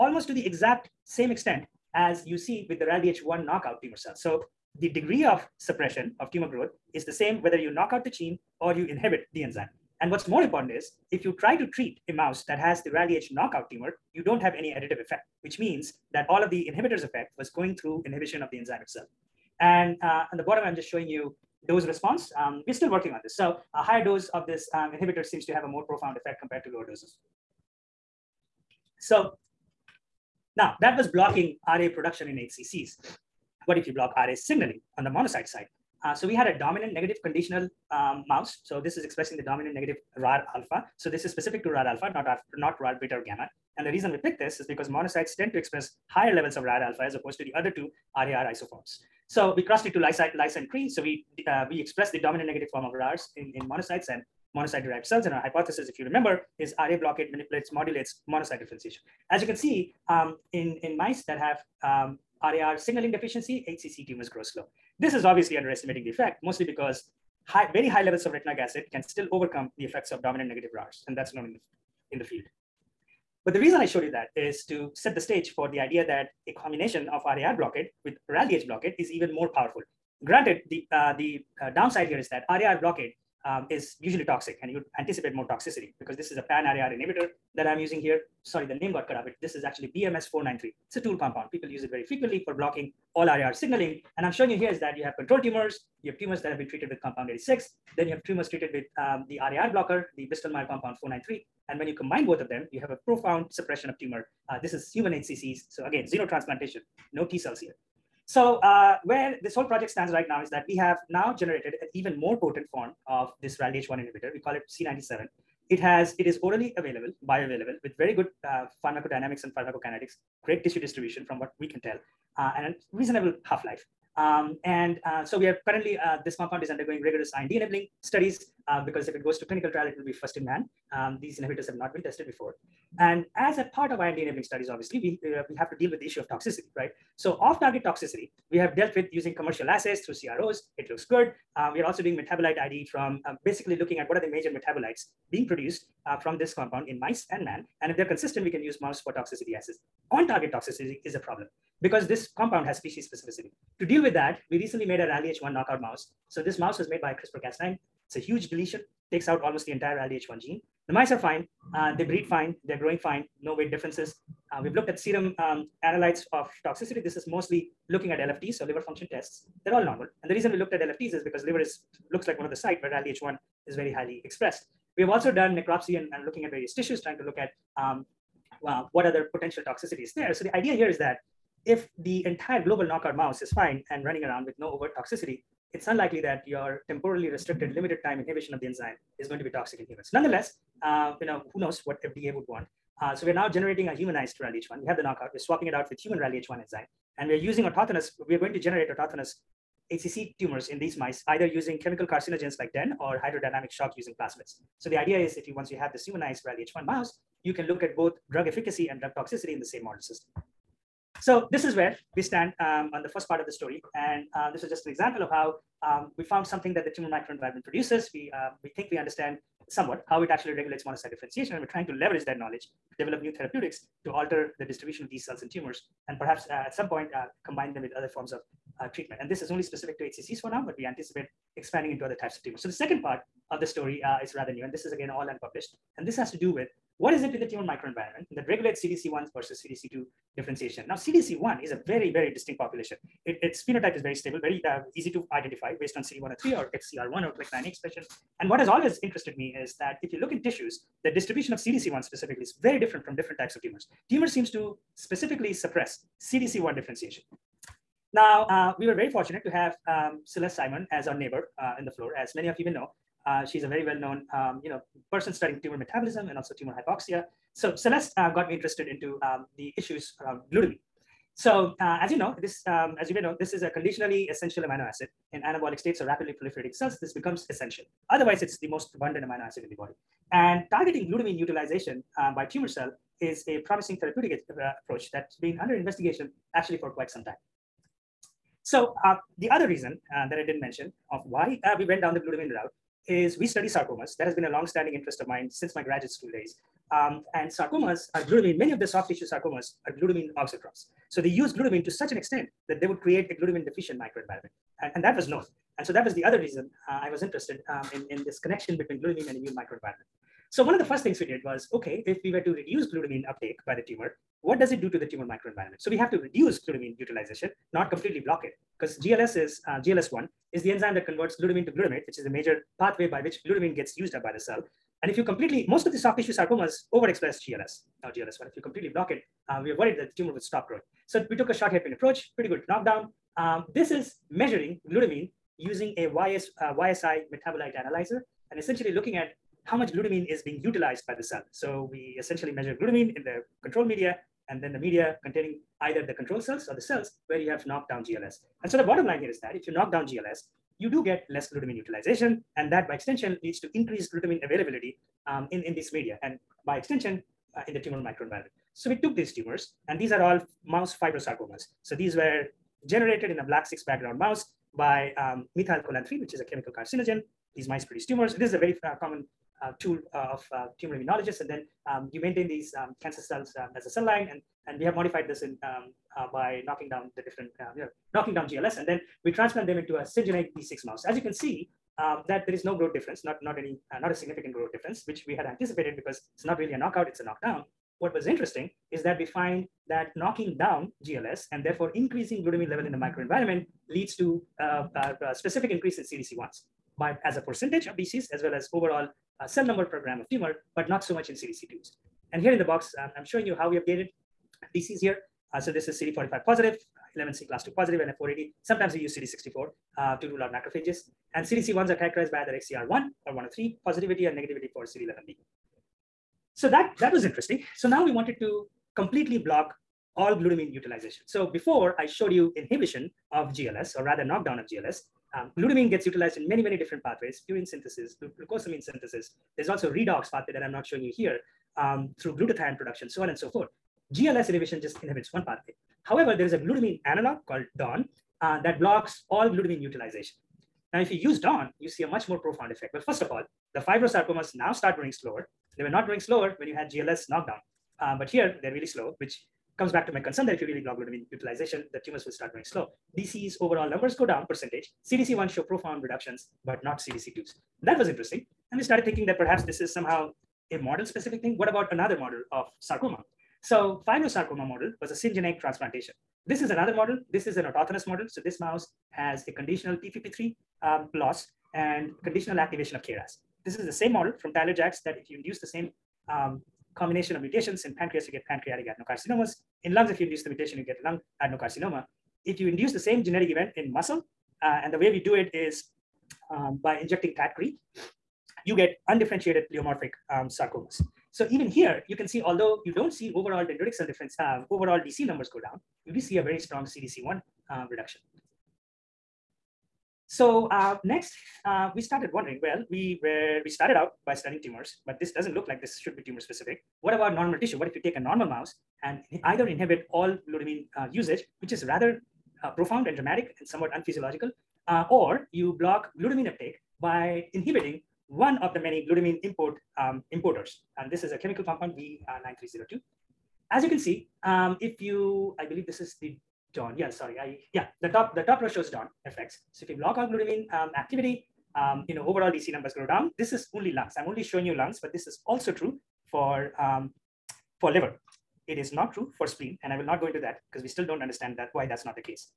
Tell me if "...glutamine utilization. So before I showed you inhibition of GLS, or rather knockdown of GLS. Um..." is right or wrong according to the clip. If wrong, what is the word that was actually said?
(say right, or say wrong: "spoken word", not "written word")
right.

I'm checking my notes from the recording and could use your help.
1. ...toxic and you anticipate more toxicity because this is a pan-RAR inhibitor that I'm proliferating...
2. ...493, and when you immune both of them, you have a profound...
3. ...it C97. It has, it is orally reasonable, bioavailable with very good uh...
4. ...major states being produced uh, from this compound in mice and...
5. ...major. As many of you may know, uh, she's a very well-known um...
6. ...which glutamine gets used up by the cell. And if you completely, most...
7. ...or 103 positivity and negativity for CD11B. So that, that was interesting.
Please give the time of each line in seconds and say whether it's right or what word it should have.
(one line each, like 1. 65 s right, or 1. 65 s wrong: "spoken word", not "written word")
1. 84 s wrong: "using", not "proliferating"
2. 101 s wrong: "combine", not "immune"
3. 114 s wrong: "available", not "reasonable"
4. 144 s wrong: "metabolites", not "states"
5. 261 s wrong: "floor", not "major"
6. 323 s right
7. 413 s right.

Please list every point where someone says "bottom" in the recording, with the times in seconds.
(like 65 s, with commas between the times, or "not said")
20 s, 348 s.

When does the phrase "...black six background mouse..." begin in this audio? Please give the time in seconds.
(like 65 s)
363 s.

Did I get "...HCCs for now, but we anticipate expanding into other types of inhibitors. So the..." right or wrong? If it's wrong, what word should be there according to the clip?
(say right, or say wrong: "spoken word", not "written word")
wrong: "tumors", not "inhibitors".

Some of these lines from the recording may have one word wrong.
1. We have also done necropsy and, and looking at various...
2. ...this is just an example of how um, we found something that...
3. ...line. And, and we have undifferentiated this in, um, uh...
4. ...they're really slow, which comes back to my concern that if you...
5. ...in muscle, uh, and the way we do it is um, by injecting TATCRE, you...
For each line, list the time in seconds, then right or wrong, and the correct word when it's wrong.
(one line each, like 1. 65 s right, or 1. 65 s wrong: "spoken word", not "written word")
1. 174 s right
2. 214 s right
3. 374 s wrong: "modified", not "undifferentiated"
4. 448 s right
5. 483 s right.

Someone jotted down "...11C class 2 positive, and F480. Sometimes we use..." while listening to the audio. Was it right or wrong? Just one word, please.
right.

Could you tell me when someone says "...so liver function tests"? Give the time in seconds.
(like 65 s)
168 s.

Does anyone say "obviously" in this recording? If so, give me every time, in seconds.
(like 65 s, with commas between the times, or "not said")
65 s, 134 s.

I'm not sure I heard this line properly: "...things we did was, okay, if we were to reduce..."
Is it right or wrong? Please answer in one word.
right.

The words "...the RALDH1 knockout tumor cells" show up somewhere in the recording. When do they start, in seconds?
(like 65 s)
2 s.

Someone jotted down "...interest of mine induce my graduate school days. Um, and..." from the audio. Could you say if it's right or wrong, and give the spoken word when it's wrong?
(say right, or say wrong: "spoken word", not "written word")
wrong: "since", not "induce".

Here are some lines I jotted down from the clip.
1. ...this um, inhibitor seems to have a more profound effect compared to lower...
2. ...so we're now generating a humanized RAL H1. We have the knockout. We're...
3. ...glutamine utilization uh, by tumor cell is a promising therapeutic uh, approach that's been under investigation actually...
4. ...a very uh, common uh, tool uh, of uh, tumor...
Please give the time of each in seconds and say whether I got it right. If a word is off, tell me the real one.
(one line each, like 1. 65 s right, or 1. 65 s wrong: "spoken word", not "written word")
1. 24 s right
2. 193 s right
3. 281 s right
4. 368 s right.